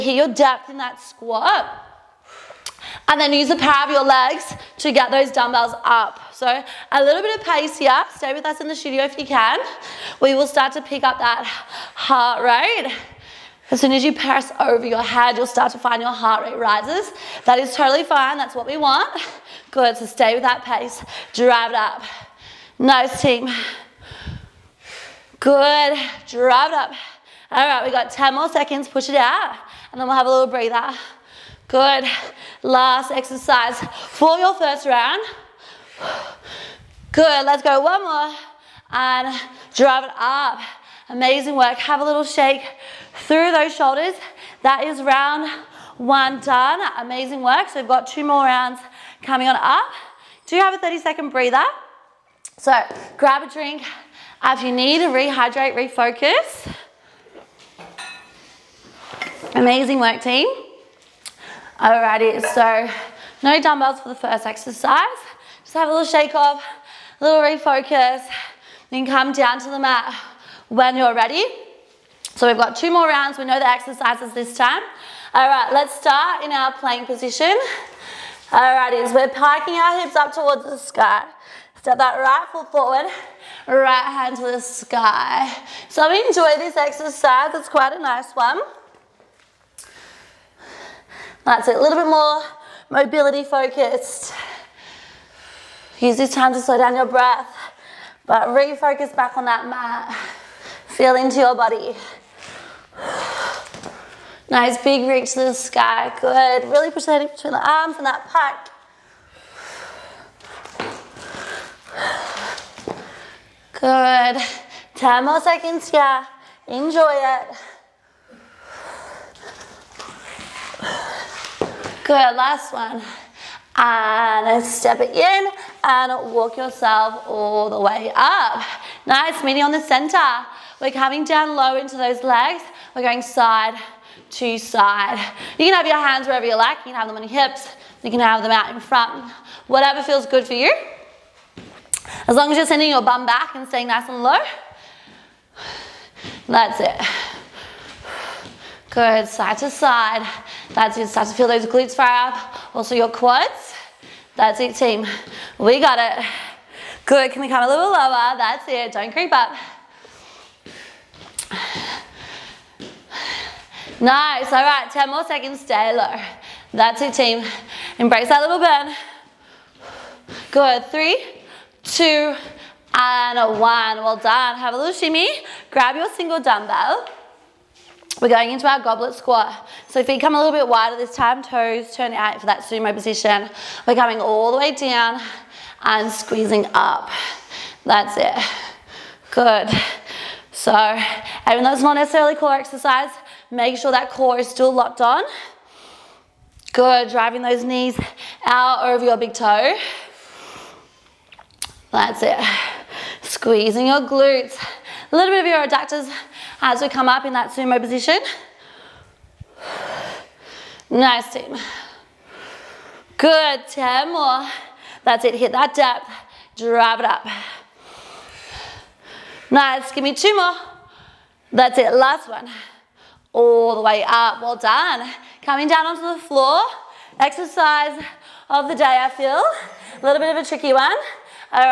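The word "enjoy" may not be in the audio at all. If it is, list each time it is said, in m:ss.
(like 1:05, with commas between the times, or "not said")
1:26, 1:56.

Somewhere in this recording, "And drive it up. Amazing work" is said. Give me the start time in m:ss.
0:38.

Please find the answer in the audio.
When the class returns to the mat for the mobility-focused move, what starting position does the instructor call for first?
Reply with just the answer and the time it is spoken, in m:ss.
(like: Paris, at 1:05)
plank position, at 1:16.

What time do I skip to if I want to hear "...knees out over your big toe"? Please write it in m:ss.
3:17.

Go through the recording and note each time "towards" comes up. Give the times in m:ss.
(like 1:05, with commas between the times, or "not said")
1:20.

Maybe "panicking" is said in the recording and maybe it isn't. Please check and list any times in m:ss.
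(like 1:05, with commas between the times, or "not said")
not said.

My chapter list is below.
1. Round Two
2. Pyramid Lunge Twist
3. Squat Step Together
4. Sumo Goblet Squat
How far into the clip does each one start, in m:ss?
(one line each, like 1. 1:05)
1. 0:47
2. 1:20
3. 2:09
4. 2:59.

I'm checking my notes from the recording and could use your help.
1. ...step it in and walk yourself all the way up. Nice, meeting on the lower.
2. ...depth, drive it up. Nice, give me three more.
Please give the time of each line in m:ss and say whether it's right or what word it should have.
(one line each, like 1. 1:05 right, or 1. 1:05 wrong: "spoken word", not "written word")
1. 2:04 wrong: "center", not "lower"
2. 3:35 wrong: "two", not "three".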